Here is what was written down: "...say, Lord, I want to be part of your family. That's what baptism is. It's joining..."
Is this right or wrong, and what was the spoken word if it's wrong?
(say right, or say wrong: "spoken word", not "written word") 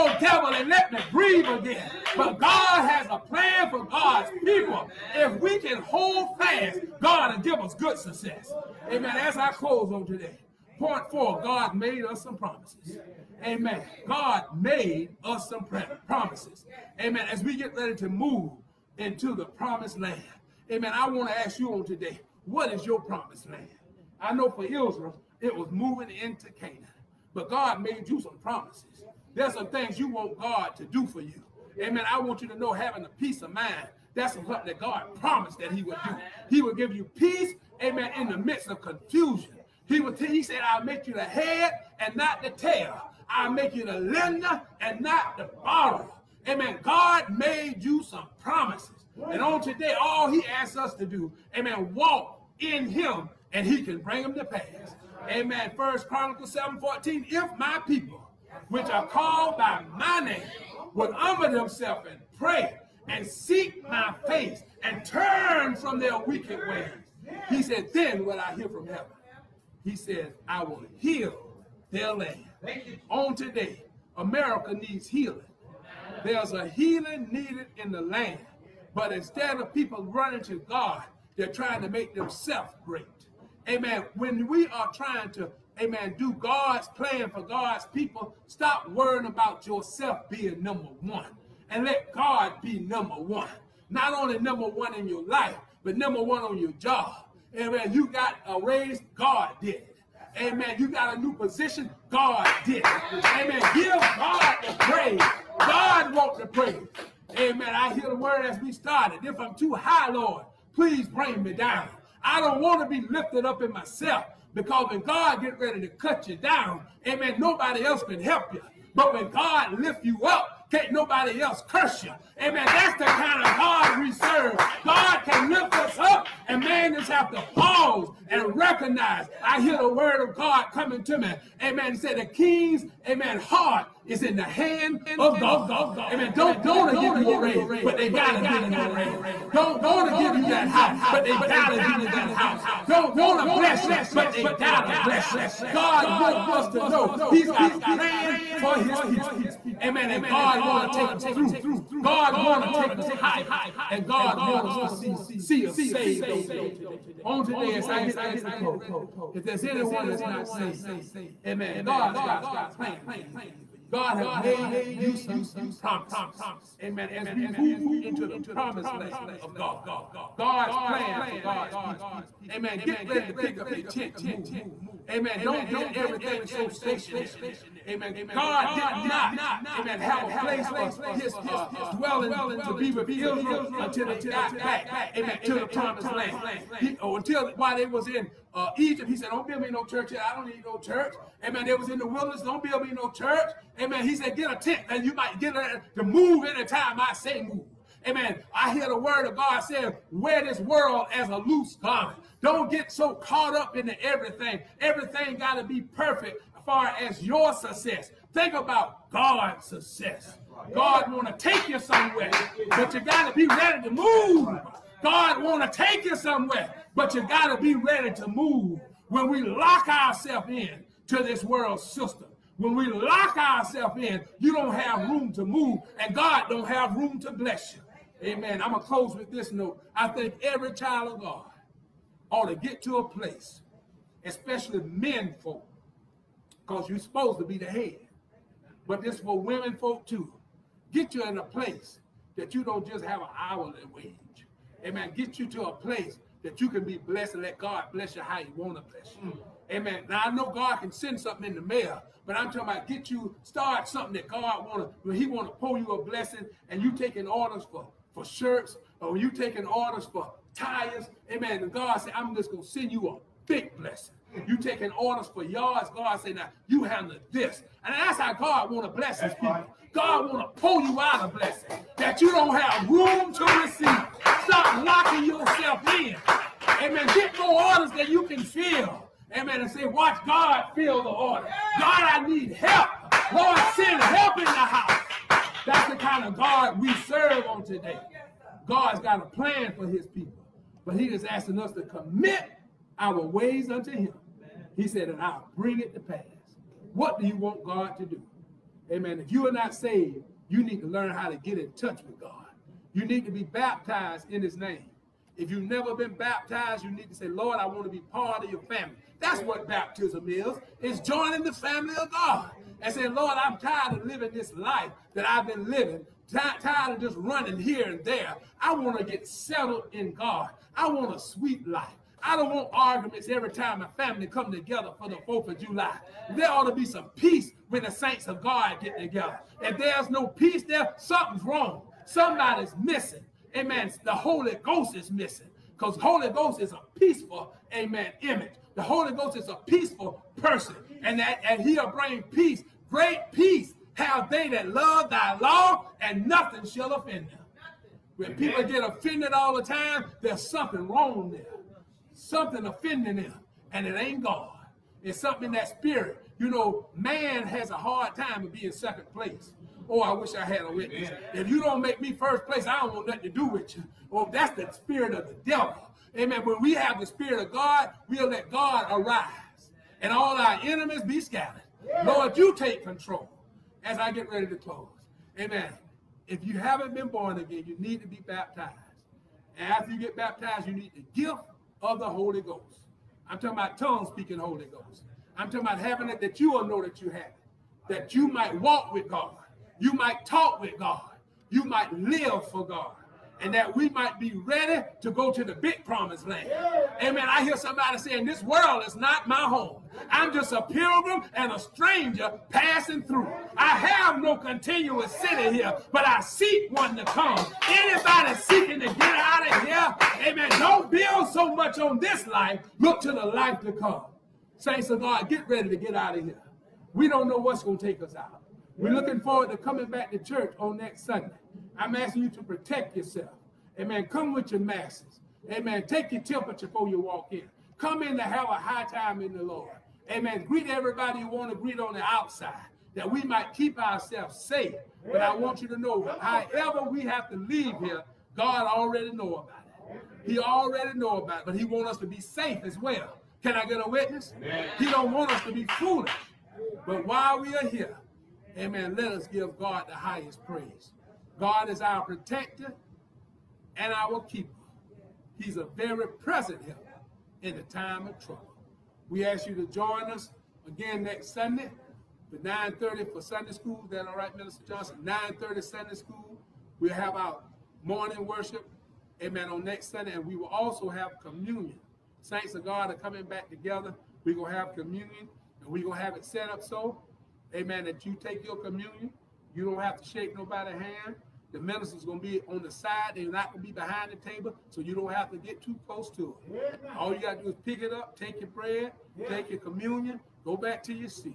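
right.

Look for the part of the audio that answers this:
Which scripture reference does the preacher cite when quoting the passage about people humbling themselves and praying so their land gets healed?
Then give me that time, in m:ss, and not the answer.
0:55.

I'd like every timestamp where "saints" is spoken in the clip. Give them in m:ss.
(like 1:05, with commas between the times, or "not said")
5:27, 6:54, 7:52.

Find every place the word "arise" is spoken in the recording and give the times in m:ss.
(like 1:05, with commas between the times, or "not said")
6:08.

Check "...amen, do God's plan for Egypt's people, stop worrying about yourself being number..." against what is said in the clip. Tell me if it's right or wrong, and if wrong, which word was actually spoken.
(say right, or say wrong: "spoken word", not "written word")
wrong: "God", not "Egypt".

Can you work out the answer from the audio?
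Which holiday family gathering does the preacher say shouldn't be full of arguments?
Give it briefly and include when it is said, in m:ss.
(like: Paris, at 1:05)
4th of July, at 5:25.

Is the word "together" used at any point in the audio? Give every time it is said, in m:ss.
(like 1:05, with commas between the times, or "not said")
5:24, 5:28, 7:53.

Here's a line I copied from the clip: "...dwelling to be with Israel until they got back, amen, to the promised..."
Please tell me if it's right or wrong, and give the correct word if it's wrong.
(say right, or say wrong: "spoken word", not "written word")
right.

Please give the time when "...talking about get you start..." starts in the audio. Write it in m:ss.
4:12.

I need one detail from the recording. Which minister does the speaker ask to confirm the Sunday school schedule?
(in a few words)
Minister Johnson.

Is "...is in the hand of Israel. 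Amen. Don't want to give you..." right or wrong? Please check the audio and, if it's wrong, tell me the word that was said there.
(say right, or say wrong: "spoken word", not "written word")
wrong: "God", not "Israel".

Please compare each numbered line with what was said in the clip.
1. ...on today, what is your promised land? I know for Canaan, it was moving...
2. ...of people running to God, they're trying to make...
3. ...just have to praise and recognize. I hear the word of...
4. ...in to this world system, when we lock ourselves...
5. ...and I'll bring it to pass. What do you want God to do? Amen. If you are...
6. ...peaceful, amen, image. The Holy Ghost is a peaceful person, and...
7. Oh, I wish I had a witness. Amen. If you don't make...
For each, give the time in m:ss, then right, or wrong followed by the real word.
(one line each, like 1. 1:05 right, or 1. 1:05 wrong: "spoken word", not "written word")
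1. 0:21 wrong: "Israel", not "Canaan"
2. 1:19 right
3. 2:06 wrong: "pause", not "praise"
4. 3:40 right
5. 4:55 right
6. 5:36 right
7. 5:59 right.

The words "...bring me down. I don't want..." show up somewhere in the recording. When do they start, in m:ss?
1:51.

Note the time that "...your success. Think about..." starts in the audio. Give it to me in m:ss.
3:27.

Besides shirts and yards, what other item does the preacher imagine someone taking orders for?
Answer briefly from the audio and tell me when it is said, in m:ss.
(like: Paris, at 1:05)
Tires, at 4:20.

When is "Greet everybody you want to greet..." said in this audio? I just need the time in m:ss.
7:10.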